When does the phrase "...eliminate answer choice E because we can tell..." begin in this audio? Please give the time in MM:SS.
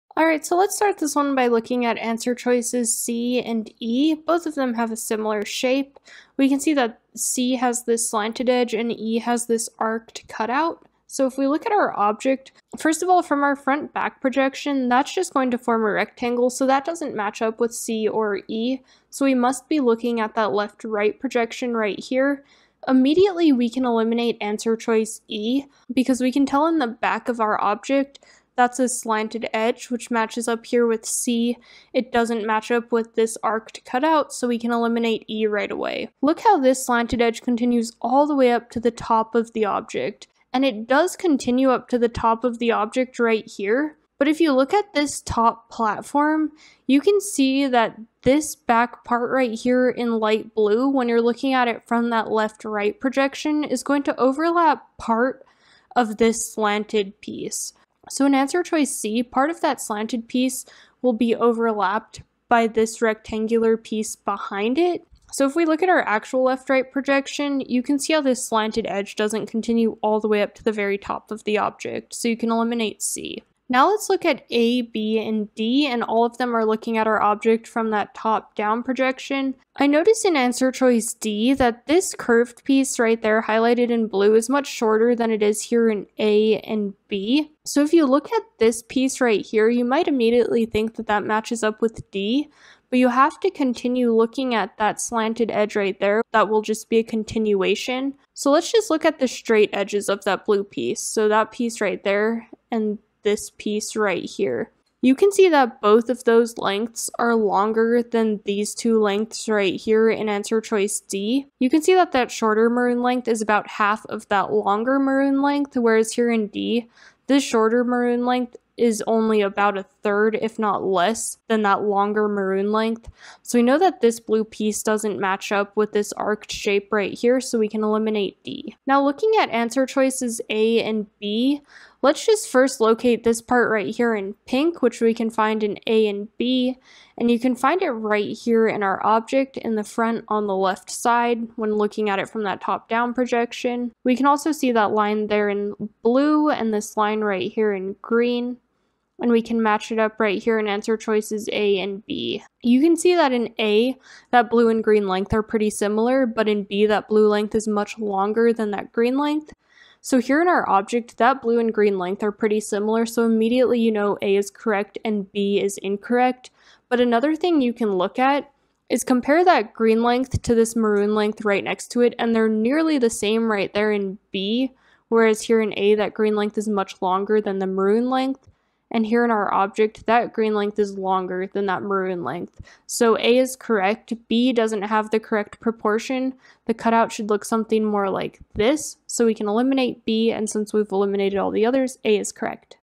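00:23.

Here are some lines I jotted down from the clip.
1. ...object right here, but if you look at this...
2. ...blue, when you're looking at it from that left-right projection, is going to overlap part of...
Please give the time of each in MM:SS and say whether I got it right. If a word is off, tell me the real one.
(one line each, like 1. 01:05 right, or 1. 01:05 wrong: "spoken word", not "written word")
1. 00:42 right
2. 00:50 right.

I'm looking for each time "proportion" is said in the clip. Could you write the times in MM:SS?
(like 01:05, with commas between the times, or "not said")
03:05.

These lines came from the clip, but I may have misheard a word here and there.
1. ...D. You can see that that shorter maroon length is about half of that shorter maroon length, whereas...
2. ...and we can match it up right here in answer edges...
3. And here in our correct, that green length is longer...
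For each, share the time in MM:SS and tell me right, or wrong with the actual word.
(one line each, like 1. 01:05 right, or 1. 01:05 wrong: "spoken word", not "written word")
1. 01:50 wrong: "longer", not "shorter"
2. 02:29 wrong: "choices", not "edges"
3. 02:58 wrong: "object", not "correct".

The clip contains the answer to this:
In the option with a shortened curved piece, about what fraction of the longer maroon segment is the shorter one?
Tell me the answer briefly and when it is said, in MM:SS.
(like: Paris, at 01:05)
a third, at 01:59.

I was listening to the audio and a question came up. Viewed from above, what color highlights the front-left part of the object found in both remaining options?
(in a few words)
pink.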